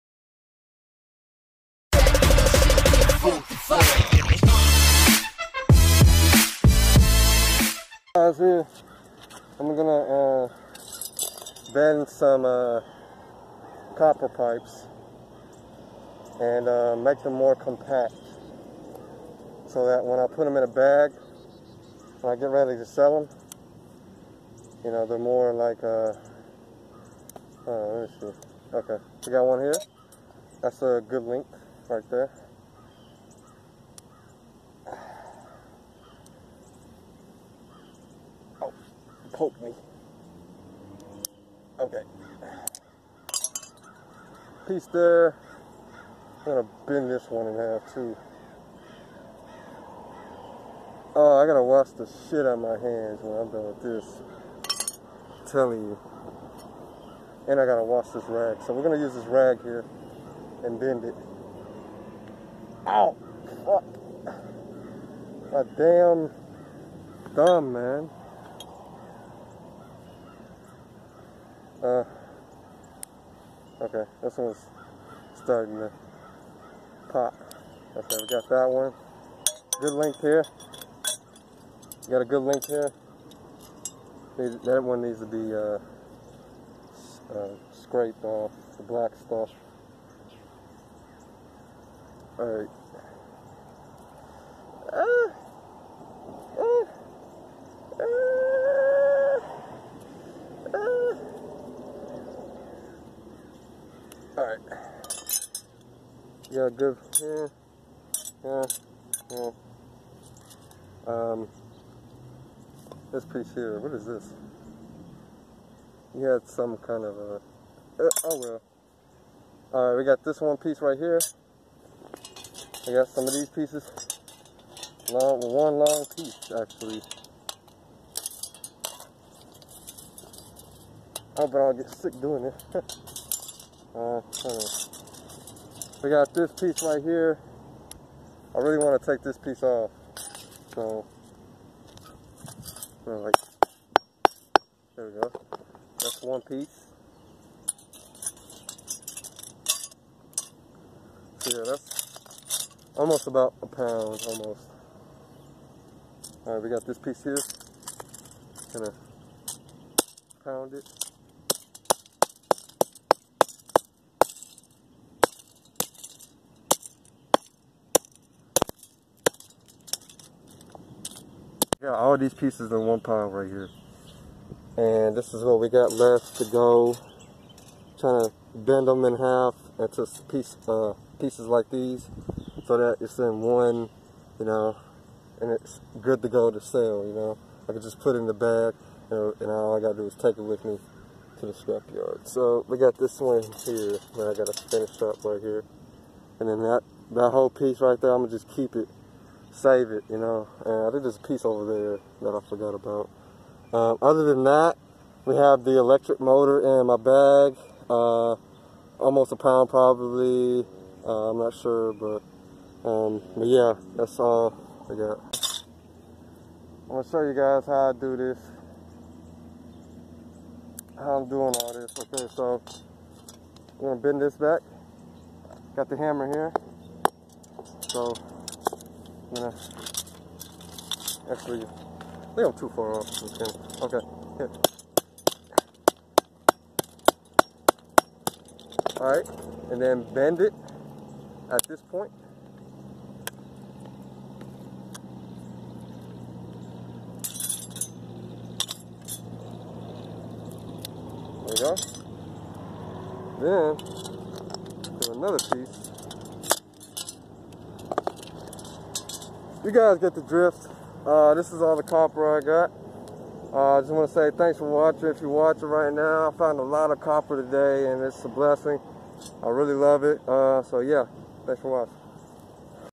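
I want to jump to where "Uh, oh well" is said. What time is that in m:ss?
1:57.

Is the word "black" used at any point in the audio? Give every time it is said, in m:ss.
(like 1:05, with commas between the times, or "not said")
1:28.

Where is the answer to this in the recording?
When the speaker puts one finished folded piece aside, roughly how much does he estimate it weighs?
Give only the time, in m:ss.
2:32.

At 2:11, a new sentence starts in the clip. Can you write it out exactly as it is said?
I hope I don't get sick doing it.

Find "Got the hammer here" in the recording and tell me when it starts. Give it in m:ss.
3:45.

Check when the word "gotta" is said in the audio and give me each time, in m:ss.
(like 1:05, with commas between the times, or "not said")
0:51, 0:57, 3:09, 3:14.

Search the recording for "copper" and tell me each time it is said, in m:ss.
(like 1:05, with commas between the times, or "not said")
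0:13, 4:21, 4:26.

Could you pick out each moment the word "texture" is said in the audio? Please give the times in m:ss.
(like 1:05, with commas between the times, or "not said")
not said.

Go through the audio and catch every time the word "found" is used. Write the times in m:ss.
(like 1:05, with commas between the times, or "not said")
4:26.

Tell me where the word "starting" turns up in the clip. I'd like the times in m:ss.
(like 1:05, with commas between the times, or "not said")
1:15.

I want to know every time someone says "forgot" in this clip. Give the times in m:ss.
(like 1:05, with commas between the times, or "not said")
3:22.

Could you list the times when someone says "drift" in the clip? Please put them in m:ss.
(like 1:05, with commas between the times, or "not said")
4:20.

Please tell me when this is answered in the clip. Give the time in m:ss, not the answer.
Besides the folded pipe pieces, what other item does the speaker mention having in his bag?
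3:25.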